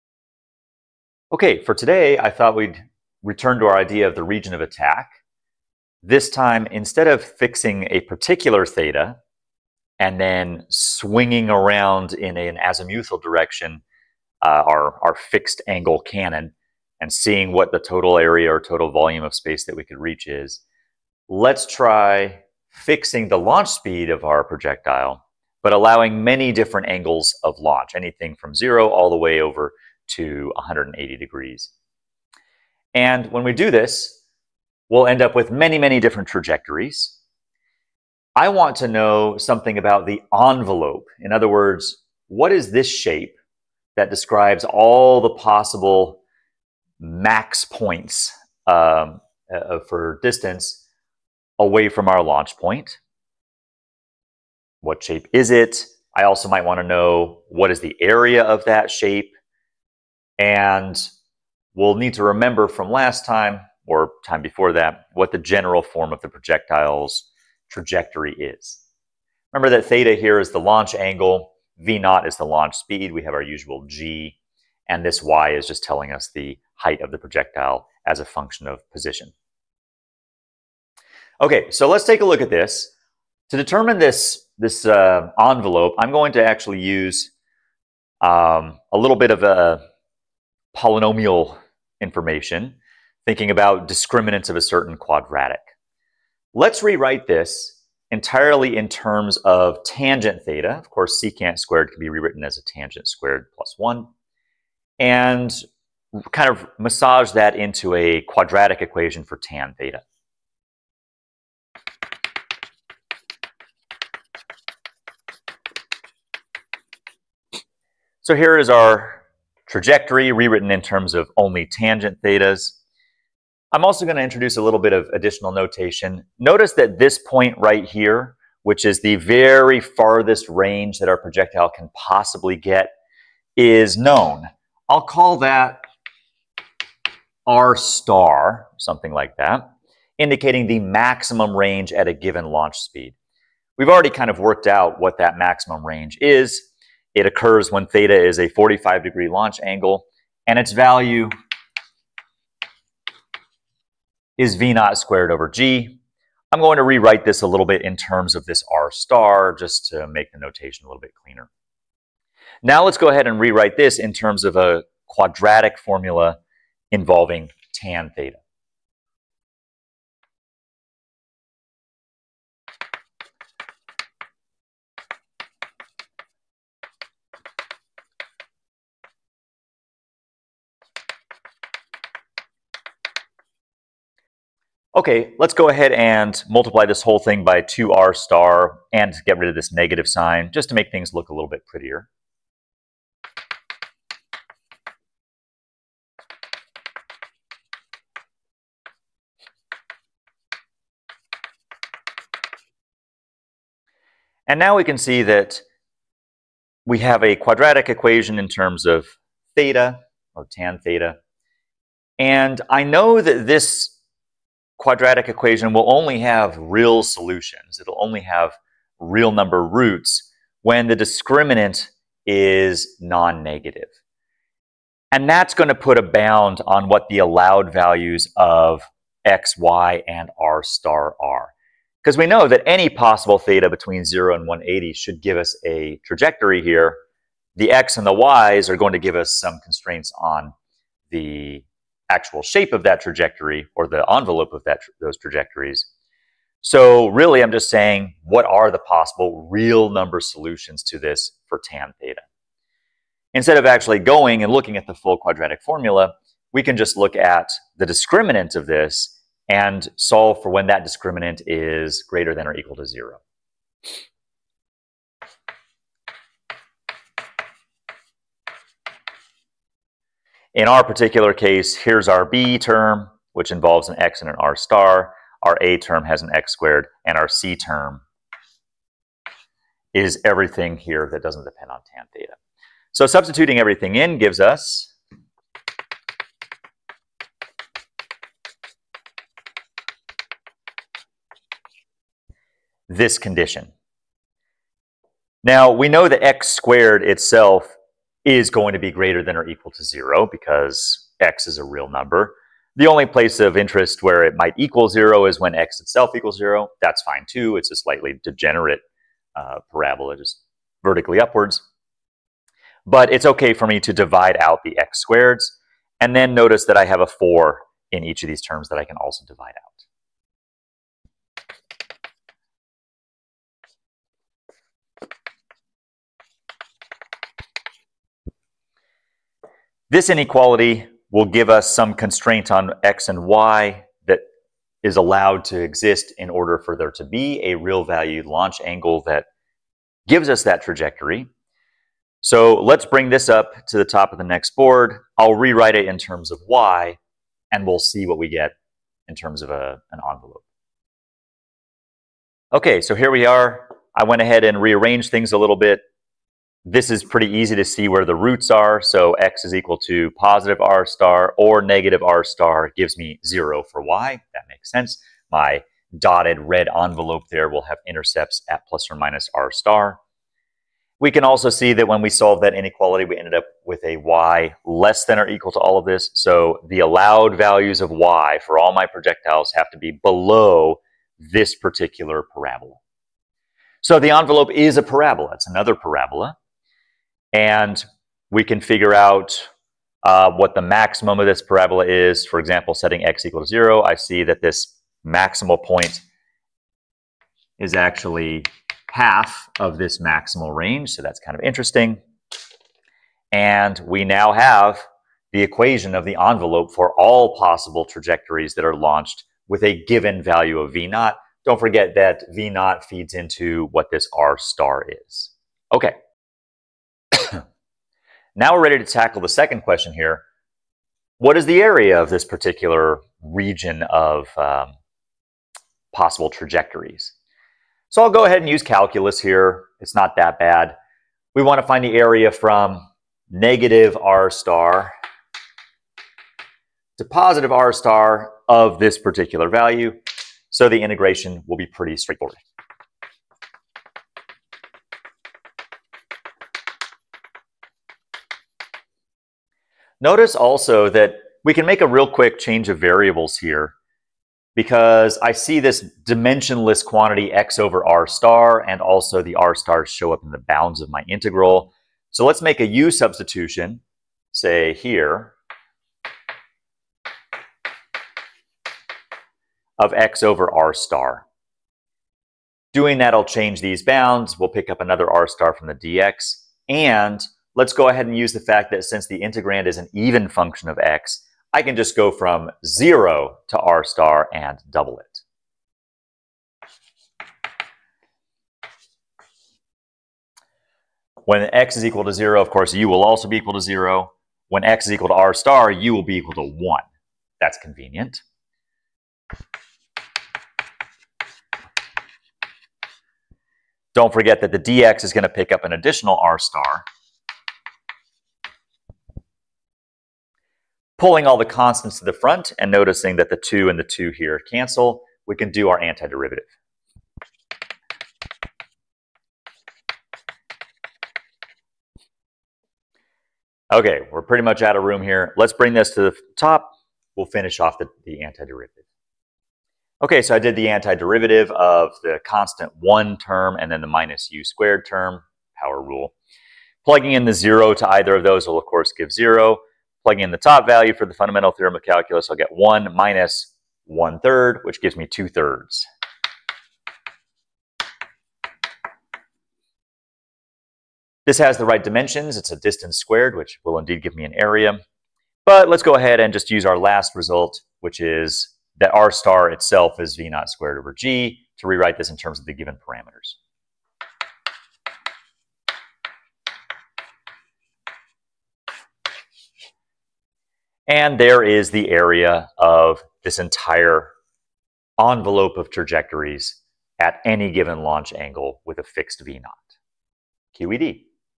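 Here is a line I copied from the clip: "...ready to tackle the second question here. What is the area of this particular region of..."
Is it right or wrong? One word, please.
right.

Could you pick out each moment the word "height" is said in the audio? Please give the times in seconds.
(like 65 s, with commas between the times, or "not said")
76 s.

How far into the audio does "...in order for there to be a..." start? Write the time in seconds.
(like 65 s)
336 s.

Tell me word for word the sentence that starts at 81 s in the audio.
Okay, so let's take a look at this.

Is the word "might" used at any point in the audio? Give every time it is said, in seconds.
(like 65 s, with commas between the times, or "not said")
56 s, 304 s.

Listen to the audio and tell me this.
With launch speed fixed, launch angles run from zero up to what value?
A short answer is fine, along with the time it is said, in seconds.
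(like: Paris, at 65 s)
180 degrees, at 30 s.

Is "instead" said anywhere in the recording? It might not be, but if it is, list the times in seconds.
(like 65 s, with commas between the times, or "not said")
6 s, 253 s.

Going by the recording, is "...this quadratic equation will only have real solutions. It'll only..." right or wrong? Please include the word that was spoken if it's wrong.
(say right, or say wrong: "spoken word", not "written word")
right.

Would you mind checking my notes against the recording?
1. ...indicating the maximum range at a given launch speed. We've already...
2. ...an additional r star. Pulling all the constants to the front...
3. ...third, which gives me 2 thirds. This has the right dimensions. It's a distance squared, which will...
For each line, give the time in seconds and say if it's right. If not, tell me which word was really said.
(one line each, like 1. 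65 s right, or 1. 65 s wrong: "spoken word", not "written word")
1. 140 s right
2. 505 s right
3. 544 s right.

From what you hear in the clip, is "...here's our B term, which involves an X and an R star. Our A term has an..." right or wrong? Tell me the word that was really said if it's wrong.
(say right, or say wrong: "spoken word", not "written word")
right.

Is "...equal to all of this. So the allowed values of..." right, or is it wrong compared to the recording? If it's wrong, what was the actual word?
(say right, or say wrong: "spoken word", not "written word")
right.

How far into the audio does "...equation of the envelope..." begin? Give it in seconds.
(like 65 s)
405 s.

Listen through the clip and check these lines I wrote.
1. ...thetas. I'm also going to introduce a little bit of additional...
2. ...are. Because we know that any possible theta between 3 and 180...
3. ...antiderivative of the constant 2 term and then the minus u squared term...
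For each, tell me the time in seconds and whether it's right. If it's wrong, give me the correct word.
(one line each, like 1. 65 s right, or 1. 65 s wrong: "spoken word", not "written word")
1. 122 s right
2. 231 s wrong: "0", not "3"
3. 530 s wrong: "1", not "2".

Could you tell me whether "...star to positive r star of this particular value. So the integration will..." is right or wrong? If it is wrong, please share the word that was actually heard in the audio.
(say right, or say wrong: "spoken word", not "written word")
right.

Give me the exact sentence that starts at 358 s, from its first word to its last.
So x is equal to positive r star or negative r star gives me zero for y.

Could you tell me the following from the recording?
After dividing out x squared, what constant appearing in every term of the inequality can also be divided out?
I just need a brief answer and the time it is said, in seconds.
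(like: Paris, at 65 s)
4, at 317 s.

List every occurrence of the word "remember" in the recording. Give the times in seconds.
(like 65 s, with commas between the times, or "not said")
62 s, 69 s.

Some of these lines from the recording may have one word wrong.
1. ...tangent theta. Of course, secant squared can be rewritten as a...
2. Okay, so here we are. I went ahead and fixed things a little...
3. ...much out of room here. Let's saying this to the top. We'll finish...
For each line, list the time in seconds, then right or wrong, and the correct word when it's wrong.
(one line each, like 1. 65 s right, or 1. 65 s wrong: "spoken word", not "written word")
1. 99 s right
2. 352 s wrong: "rearranged", not "fixed"
3. 524 s wrong: "bring", not "saying".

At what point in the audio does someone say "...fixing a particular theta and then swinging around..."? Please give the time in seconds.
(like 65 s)
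7 s.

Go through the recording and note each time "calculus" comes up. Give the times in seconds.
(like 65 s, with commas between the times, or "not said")
428 s, 541 s.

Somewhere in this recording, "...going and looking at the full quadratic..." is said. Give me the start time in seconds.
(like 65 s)
253 s.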